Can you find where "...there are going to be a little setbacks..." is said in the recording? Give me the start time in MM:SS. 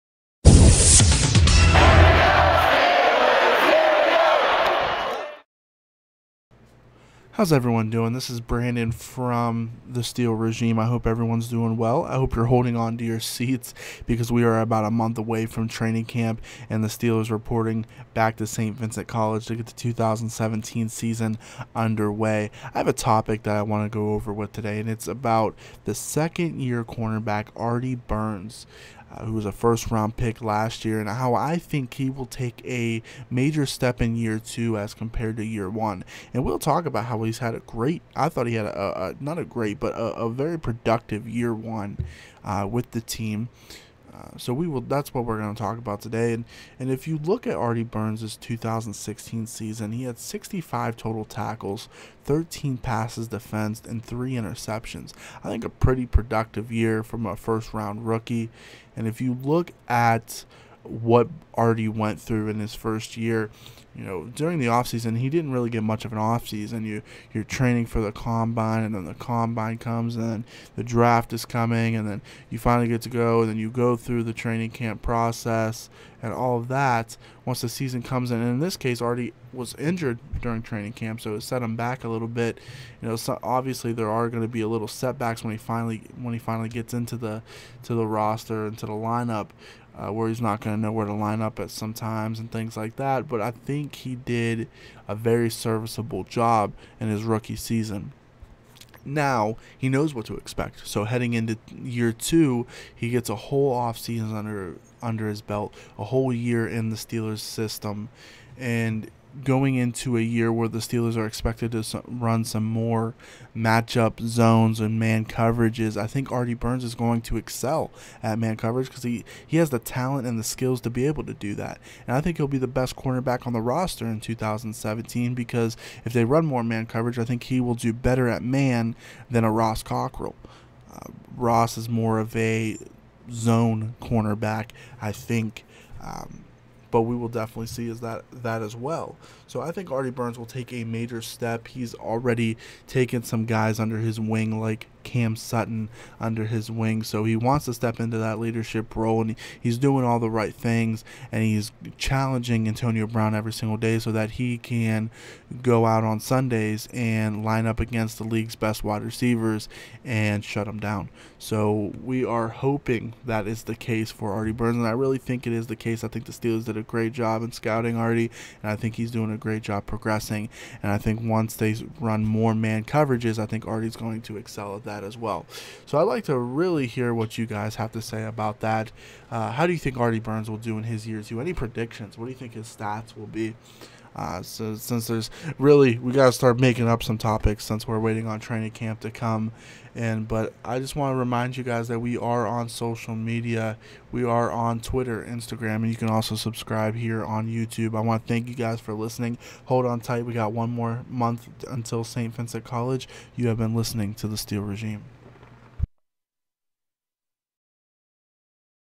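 01:23.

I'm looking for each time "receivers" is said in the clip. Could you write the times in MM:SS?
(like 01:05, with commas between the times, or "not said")
02:39.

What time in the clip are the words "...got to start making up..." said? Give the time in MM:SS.
03:06.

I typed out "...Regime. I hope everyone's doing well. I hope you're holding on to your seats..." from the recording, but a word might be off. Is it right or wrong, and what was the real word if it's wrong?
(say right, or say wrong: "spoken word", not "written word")
right.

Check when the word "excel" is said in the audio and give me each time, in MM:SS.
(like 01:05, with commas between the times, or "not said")
01:57, 02:54.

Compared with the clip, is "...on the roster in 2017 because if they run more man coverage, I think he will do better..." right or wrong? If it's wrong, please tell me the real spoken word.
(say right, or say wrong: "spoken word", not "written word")
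right.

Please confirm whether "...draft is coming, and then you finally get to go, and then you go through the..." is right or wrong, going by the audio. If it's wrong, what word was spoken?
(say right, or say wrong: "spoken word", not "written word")
right.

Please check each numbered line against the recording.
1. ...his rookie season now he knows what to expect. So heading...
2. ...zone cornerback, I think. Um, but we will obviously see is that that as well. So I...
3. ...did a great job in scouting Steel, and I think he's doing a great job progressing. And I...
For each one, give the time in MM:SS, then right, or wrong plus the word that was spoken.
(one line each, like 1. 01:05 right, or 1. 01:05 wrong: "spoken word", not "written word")
1. 01:37 right
2. 02:13 wrong: "definitely", not "obviously"
3. 02:46 wrong: "Artie", not "Steel".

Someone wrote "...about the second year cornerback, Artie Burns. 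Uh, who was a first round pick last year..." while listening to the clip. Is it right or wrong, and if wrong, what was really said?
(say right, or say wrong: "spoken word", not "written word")
right.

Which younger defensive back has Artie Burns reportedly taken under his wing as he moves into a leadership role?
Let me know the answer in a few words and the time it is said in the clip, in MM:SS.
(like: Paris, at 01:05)
Cam Sutton, at 02:25.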